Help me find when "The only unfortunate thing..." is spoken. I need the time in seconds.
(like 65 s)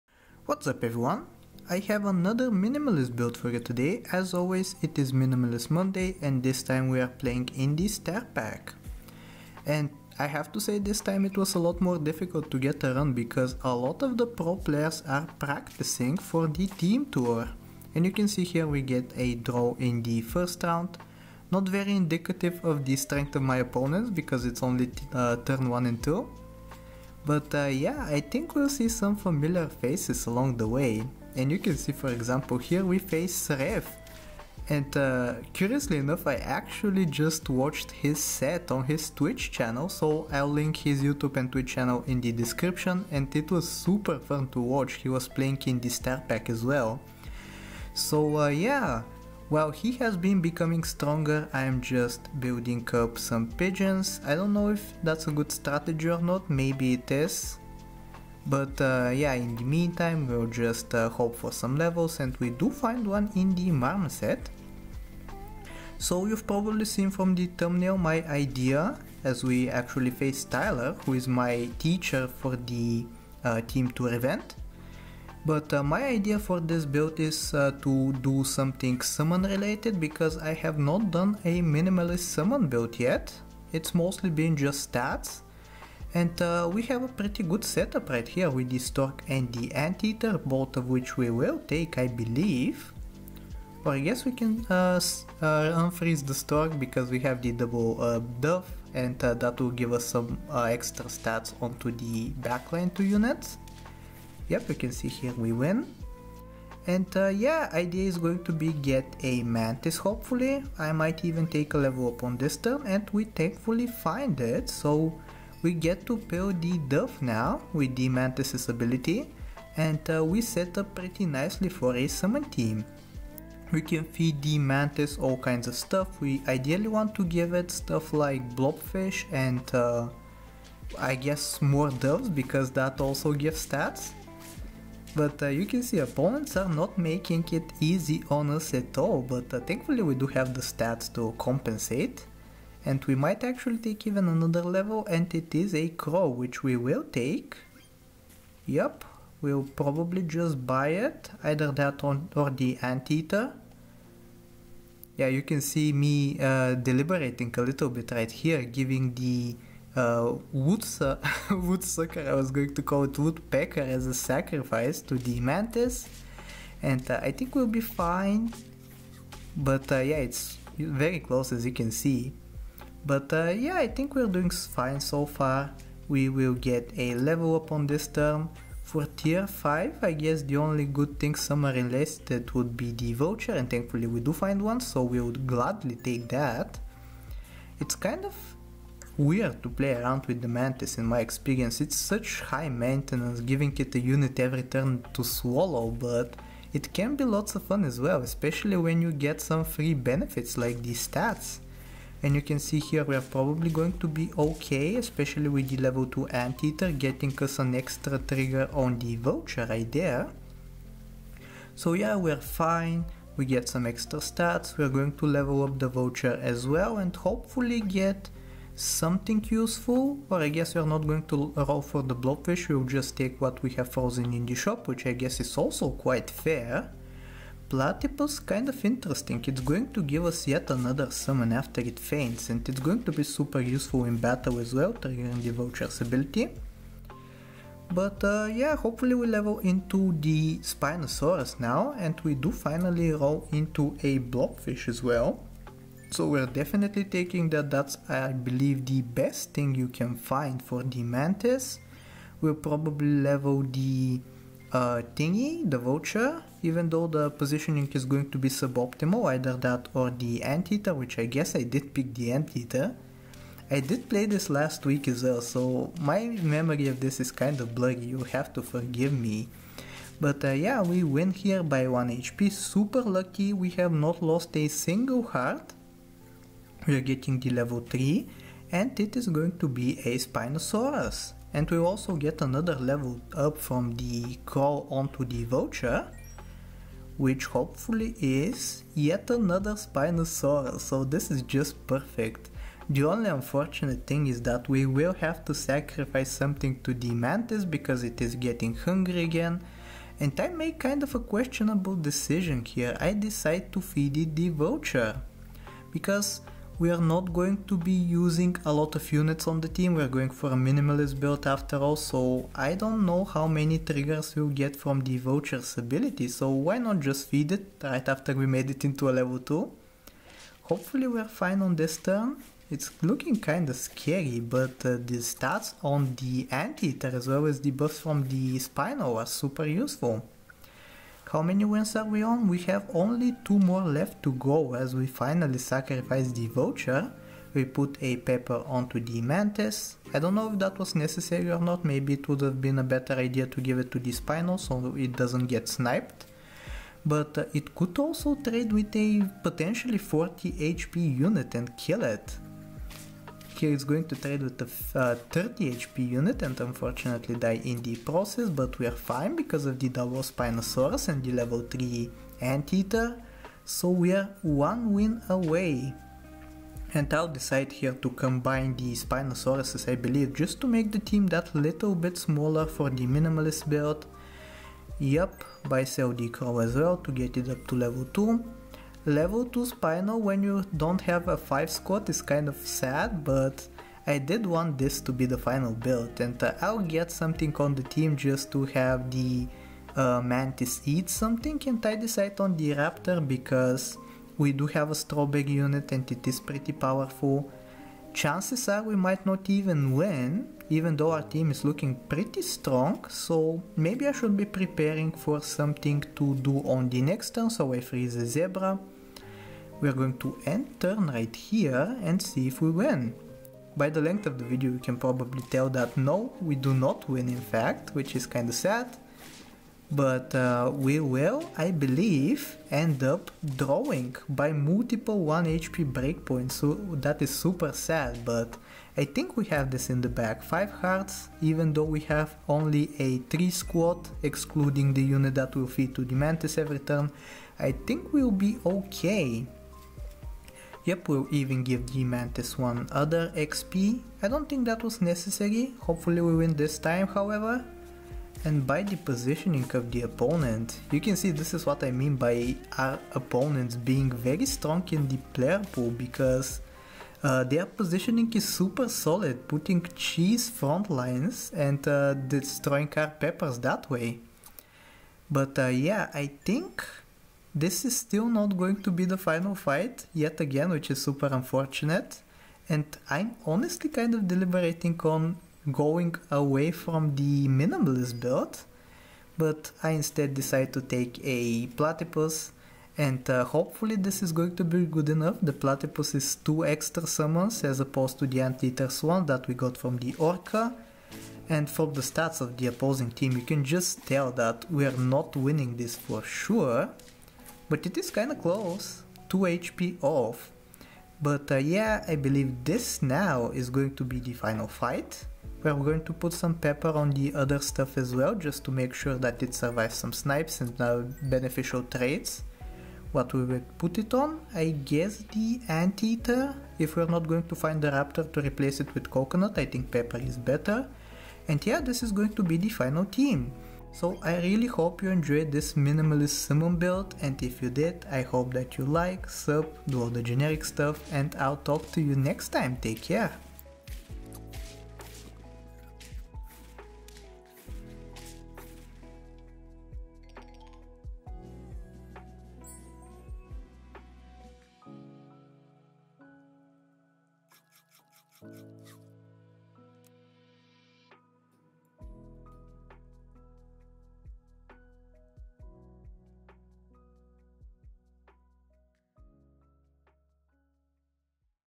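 292 s.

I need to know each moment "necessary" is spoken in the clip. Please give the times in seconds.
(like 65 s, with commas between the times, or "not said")
340 s, 445 s.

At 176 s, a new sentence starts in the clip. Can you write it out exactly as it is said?
We will get a level up on this term.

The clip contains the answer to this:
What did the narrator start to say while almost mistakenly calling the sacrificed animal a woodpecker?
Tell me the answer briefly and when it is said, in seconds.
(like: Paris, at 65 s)
woodsu-, at 160 s.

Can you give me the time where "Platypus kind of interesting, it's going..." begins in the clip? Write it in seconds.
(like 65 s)
227 s.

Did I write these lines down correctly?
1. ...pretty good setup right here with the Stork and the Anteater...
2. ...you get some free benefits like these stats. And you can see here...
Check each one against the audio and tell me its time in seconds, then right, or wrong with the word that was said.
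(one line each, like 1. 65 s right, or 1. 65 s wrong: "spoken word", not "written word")
1. 87 s right
2. 199 s right.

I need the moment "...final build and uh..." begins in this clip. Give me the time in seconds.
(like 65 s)
385 s.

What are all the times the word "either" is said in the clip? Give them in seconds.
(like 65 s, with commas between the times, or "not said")
151 s, 259 s.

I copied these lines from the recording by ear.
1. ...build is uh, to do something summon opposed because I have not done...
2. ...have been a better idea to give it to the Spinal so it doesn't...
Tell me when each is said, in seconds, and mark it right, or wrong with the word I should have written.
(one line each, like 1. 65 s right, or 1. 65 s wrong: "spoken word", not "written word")
1. 76 s wrong: "related", not "opposed"
2. 342 s right.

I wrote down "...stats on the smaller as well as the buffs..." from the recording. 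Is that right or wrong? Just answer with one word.
wrong.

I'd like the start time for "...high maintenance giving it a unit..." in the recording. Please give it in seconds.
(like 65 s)
192 s.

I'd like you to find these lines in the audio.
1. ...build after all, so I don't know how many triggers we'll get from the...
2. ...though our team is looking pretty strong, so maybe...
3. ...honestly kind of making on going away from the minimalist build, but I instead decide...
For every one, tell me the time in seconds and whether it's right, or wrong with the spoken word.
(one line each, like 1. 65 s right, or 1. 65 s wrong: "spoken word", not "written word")
1. 311 s right
2. 400 s right
3. 473 s wrong: "deliberating", not "making".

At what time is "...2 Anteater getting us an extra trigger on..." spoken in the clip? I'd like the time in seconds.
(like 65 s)
206 s.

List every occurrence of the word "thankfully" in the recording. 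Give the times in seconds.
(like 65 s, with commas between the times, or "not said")
113 s, 139 s, 183 s.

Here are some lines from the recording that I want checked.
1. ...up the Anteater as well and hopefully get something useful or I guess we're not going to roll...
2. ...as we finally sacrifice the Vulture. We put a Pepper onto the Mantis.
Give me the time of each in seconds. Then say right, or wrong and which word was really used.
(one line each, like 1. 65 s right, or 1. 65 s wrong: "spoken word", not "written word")
1. 215 s wrong: "Vulture", not "Anteater"
2. 334 s right.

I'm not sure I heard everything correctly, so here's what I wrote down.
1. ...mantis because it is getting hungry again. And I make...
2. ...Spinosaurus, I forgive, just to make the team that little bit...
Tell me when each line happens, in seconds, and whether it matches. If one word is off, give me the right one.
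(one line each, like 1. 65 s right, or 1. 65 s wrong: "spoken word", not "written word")
1. 297 s right
2. 368 s wrong: "believe", not "forgive".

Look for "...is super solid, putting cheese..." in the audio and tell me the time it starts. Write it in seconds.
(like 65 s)
458 s.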